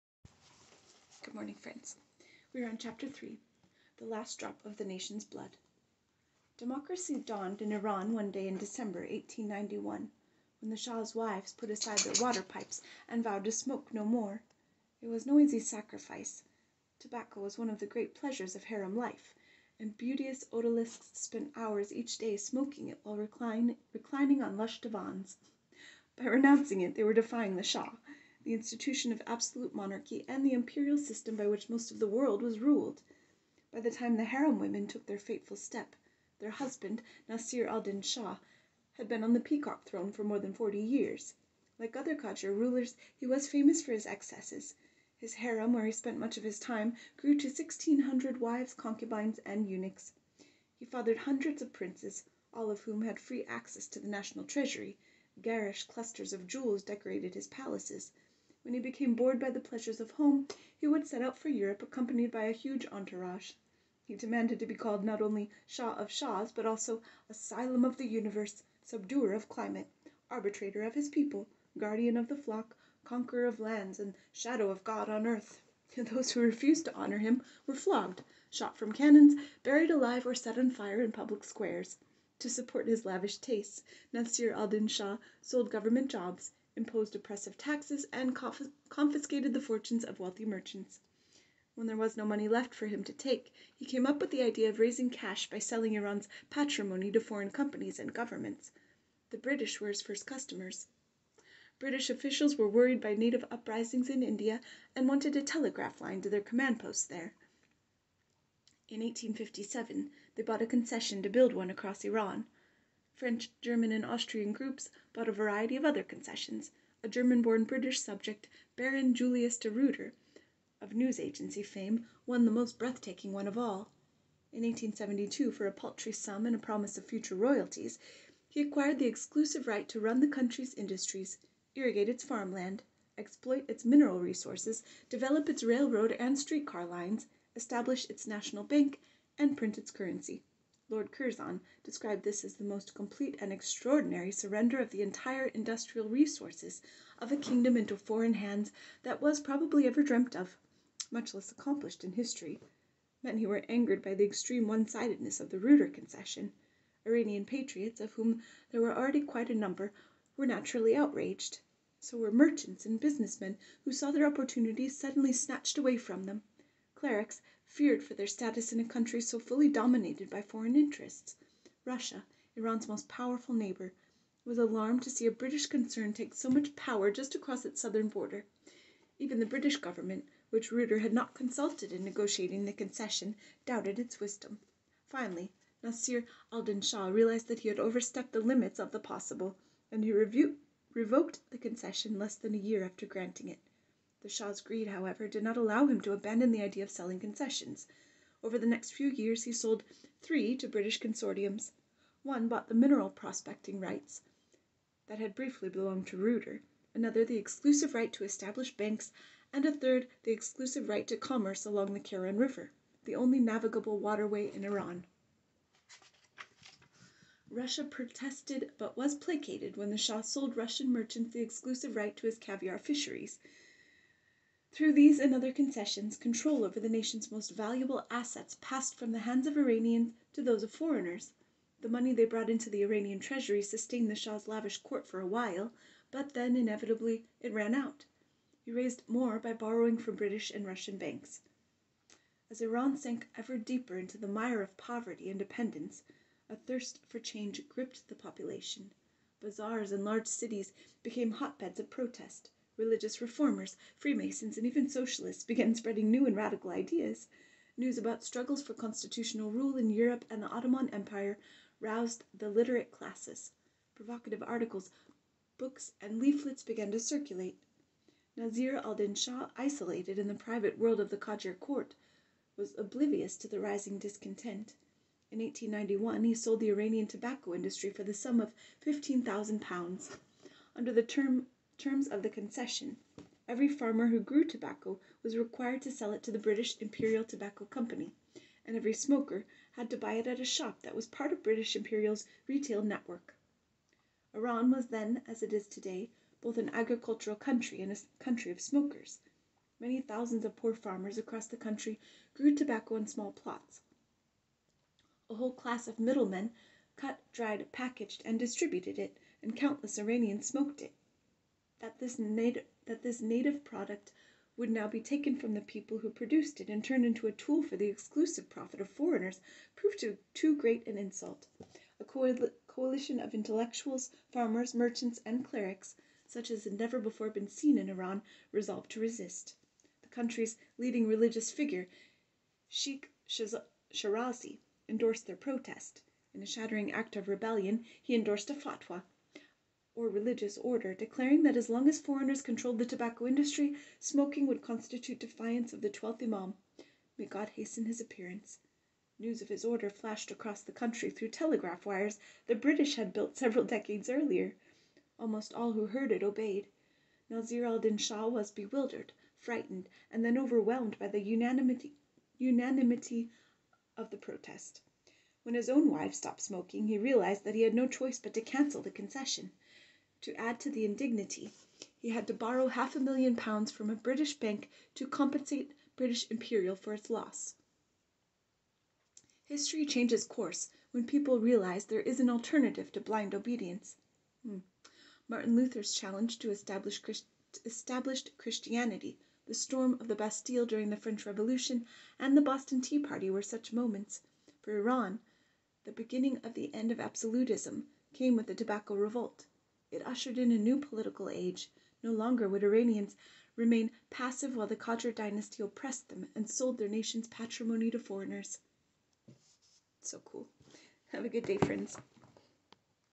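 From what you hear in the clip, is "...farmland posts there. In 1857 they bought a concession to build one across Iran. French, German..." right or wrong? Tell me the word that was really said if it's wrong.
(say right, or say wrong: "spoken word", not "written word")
wrong: "command", not "farmland".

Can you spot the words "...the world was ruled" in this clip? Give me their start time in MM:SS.
00:31.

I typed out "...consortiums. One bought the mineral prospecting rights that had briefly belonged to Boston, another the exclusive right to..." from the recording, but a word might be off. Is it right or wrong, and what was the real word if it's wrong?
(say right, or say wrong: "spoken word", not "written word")
wrong: "Reuter", not "Boston".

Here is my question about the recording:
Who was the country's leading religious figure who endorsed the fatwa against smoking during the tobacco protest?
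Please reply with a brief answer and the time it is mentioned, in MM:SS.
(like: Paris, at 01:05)
Sheikh Shirazi, at 05:32.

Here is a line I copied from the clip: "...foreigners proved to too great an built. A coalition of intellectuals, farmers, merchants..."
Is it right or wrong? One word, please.
wrong.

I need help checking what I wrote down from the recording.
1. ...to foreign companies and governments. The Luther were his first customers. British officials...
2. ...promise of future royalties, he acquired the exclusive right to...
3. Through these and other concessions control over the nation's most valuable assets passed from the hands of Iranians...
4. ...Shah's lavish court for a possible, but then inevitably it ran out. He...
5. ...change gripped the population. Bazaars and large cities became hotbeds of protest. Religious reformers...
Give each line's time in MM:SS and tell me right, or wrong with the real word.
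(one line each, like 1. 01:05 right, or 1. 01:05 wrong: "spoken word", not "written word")
1. 01:37 wrong: "British", not "Luther"
2. 02:06 right
3. 03:44 right
4. 03:54 wrong: "while", not "possible"
5. 04:07 right.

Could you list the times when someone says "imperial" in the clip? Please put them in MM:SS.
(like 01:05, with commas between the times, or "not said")
00:30, 04:46, 04:51, 06:16.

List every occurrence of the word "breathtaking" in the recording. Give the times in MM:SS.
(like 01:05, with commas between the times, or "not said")
02:02.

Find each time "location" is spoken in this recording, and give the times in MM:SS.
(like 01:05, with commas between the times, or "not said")
not said.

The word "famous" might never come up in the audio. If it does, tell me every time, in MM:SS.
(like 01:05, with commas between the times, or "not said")
00:43.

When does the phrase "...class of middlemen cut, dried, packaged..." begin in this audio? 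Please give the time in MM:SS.
05:05.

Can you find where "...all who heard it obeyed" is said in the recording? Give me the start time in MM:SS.
05:55.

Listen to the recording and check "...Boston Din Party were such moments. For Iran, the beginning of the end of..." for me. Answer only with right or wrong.
wrong.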